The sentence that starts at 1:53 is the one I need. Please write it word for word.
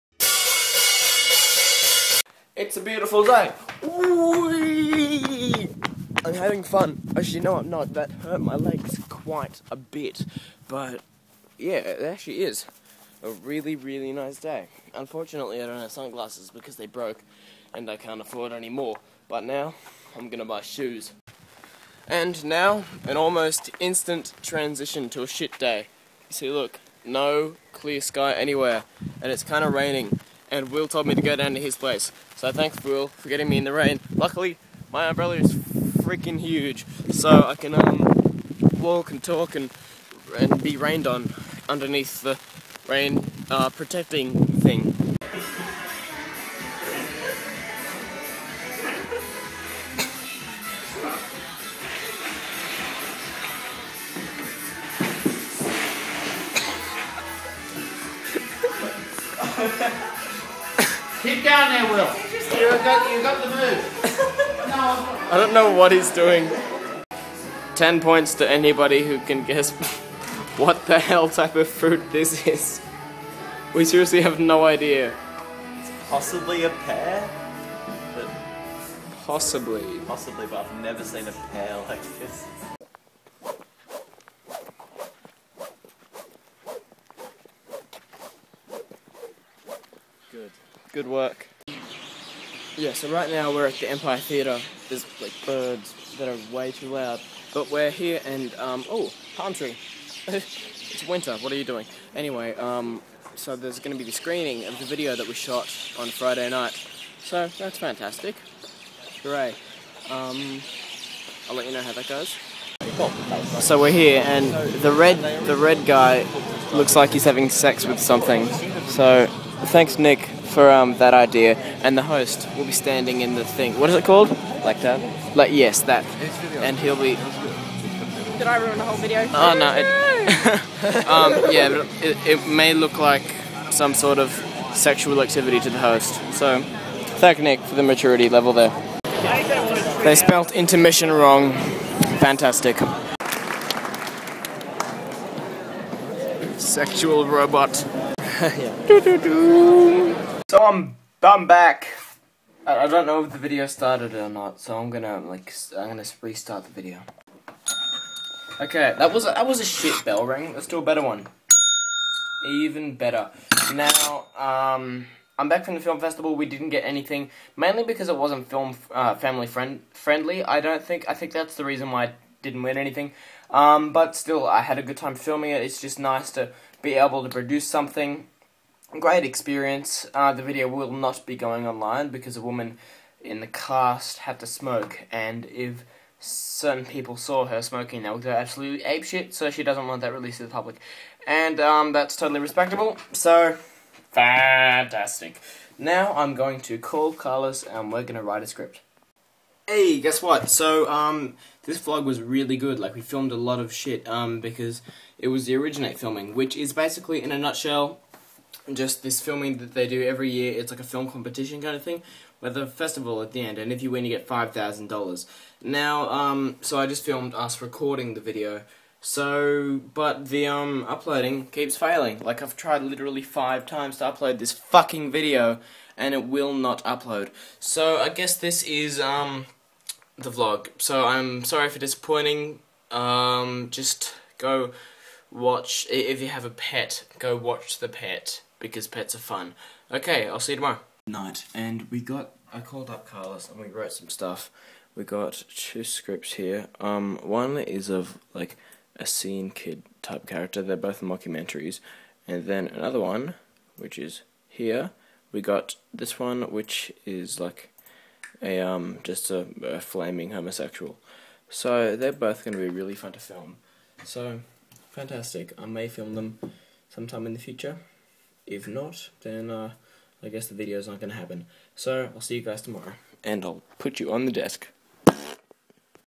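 So we're here, and the red the red guy looks like he's having sex with something.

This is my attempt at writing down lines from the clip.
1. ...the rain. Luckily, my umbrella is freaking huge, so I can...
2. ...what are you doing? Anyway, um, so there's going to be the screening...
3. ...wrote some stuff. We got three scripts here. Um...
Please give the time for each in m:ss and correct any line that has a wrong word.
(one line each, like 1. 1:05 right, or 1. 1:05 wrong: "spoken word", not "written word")
1. 0:33 right
2. 1:41 right
3. 4:03 wrong: "two", not "three".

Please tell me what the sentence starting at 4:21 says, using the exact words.
So they're both going to be really fun to film.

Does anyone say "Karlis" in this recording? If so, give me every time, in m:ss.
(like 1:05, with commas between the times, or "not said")
3:17, 4:03.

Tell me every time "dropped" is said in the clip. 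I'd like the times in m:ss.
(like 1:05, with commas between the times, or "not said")
not said.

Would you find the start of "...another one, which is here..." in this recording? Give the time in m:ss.
4:12.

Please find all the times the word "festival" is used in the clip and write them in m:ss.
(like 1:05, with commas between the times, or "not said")
2:46, 3:32.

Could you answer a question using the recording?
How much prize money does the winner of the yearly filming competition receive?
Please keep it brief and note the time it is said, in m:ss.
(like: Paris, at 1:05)
$5000, at 3:34.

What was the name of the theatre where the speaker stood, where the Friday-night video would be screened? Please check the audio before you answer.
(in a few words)
Empire Theatre.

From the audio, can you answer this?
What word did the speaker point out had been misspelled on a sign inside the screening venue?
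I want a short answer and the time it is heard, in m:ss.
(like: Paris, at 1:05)
intermission, at 2:20.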